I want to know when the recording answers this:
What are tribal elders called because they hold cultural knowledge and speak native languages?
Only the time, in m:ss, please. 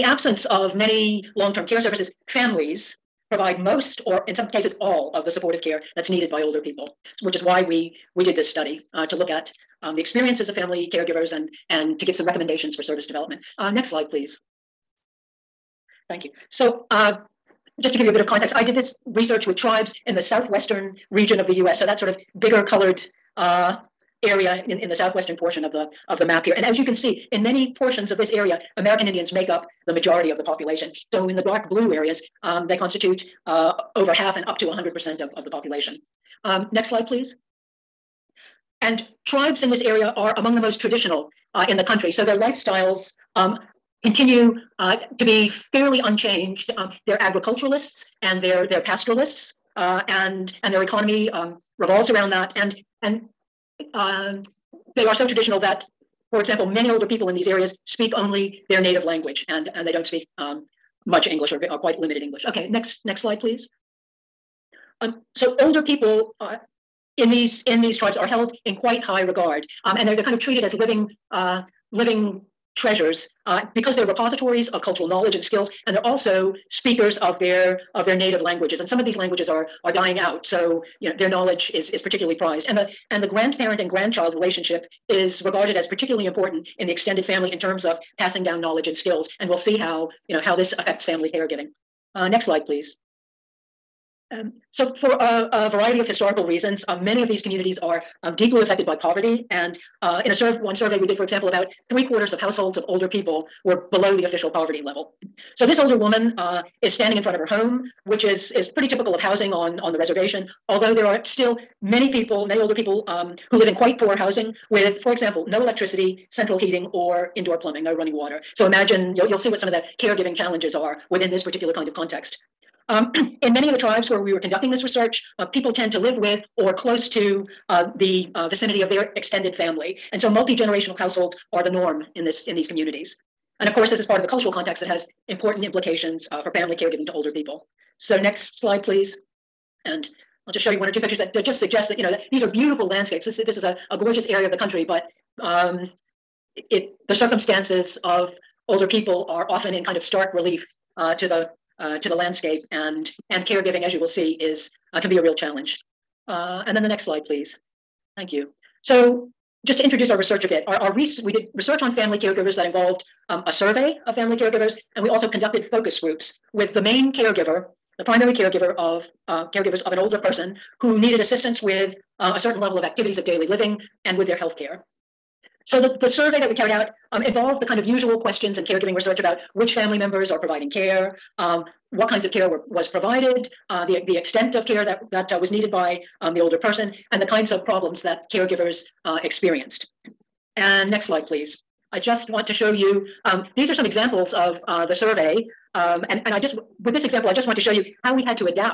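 1:11.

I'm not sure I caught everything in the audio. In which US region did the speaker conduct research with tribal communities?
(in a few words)
southwestern region.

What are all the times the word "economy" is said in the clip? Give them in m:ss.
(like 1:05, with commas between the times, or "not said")
0:50.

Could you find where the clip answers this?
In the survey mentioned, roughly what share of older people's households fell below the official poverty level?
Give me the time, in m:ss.
1:41.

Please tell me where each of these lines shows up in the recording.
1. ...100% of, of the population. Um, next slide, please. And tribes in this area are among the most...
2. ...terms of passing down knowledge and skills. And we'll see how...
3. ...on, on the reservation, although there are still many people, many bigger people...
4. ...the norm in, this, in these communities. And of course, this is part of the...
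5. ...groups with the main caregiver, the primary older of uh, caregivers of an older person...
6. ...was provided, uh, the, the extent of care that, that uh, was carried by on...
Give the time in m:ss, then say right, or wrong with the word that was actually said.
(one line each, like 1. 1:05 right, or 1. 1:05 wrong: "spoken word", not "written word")
1. 0:34 right
2. 1:27 right
3. 1:49 wrong: "older", not "bigger"
4. 2:11 right
5. 2:46 wrong: "caregiver", not "older"
6. 3:02 wrong: "needed", not "carried".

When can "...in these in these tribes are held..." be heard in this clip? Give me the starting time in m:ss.
1:07.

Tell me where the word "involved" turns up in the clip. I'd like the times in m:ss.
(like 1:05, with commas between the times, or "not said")
2:42, 2:57.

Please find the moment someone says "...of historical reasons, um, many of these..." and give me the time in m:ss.
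1:35.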